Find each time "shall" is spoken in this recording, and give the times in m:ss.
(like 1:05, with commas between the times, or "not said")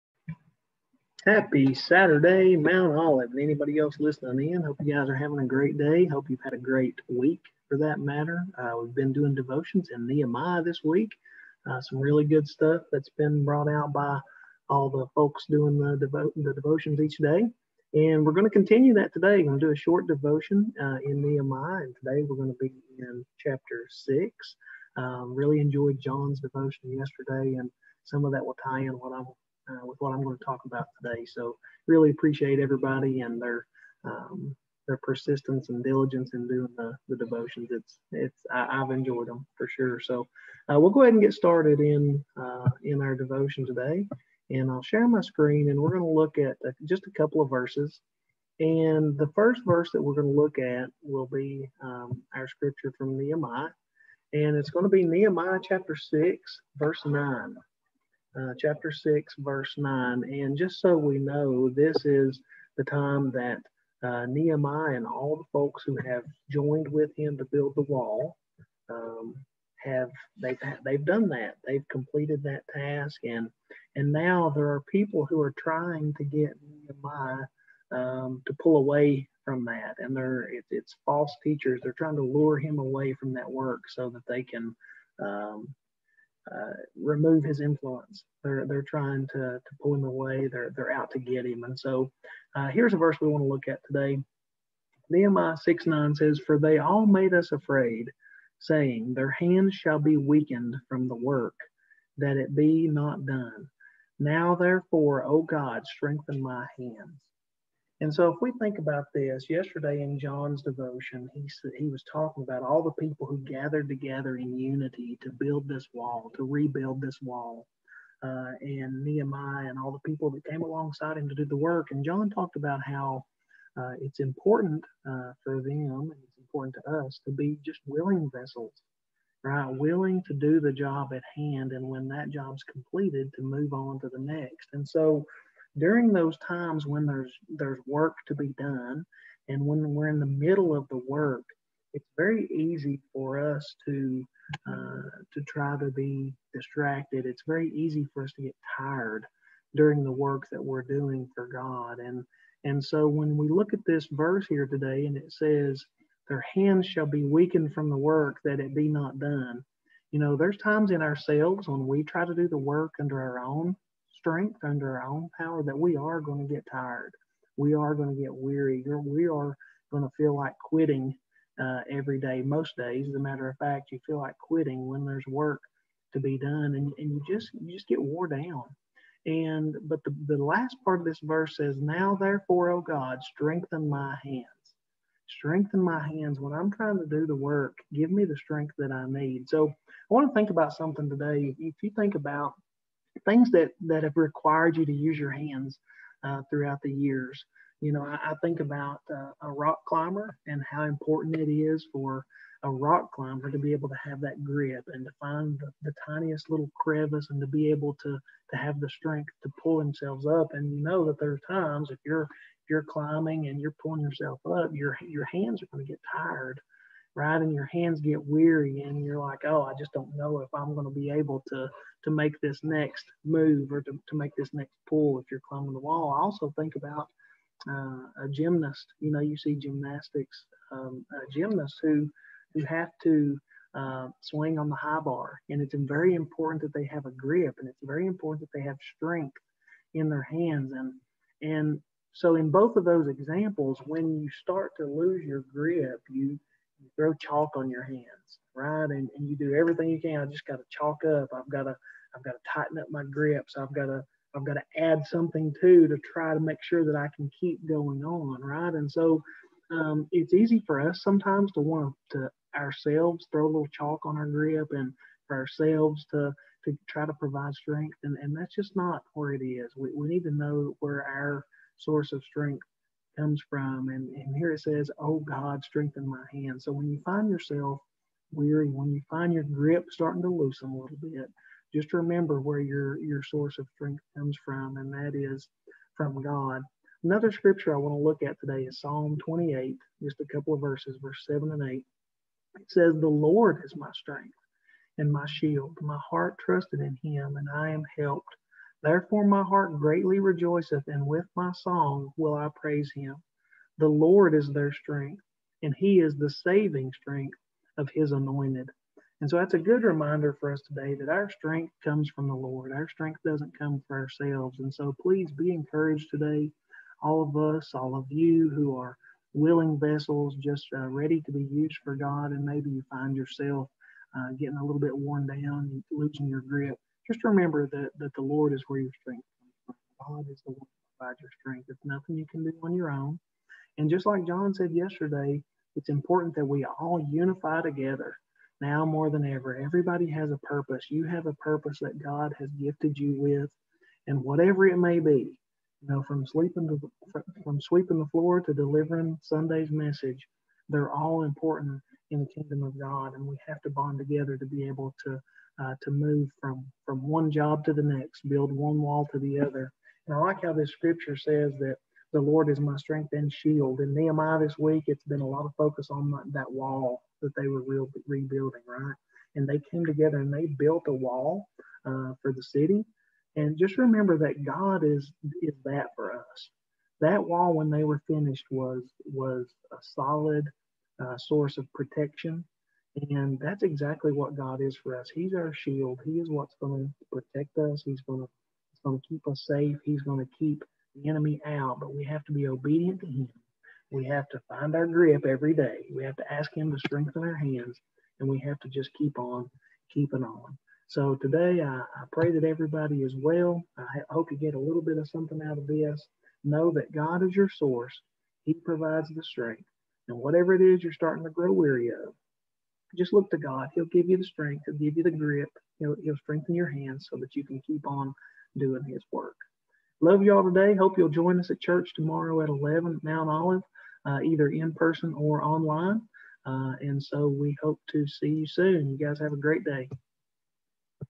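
1:39, 2:36.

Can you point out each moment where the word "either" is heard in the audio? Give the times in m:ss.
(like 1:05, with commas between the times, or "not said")
7:04.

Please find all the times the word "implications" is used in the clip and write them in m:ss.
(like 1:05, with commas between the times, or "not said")
not said.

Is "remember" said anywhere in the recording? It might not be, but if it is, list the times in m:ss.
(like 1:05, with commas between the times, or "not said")
4:41, 5:27, 6:13.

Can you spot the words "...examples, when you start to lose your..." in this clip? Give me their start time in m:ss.
4:03.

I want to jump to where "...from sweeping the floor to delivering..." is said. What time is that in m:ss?
5:47.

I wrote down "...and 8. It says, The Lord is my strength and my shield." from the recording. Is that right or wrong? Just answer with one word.
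right.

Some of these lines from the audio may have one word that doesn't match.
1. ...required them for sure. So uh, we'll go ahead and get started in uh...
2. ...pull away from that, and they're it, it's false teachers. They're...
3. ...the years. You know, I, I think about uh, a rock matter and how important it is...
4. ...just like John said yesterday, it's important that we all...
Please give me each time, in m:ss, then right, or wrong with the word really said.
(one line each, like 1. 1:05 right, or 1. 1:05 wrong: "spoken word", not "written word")
1. 0:38 wrong: "enjoyed", not "required"
2. 1:18 right
3. 3:16 wrong: "climber", not "matter"
4. 5:33 right.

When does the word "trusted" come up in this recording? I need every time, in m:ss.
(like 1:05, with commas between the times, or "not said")
4:56.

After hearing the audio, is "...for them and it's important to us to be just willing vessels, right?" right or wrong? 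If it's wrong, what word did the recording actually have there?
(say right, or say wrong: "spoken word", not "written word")
right.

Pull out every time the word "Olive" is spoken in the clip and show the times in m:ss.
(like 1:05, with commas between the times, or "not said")
0:02, 7:03.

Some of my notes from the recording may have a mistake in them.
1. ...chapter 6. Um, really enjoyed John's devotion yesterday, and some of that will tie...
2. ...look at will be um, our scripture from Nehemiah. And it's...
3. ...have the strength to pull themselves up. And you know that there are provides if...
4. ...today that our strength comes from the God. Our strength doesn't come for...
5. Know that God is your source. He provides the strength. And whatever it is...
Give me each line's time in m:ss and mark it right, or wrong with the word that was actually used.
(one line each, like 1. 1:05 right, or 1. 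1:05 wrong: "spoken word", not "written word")
1. 0:23 right
2. 0:50 right
3. 3:28 wrong: "times", not "provides"
4. 5:10 wrong: "Lord", not "God"
5. 6:46 right.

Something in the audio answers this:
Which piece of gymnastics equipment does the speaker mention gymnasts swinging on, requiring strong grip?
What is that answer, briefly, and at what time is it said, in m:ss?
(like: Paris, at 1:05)
High bar, at 3:54.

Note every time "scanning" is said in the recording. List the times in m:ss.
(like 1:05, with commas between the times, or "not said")
not said.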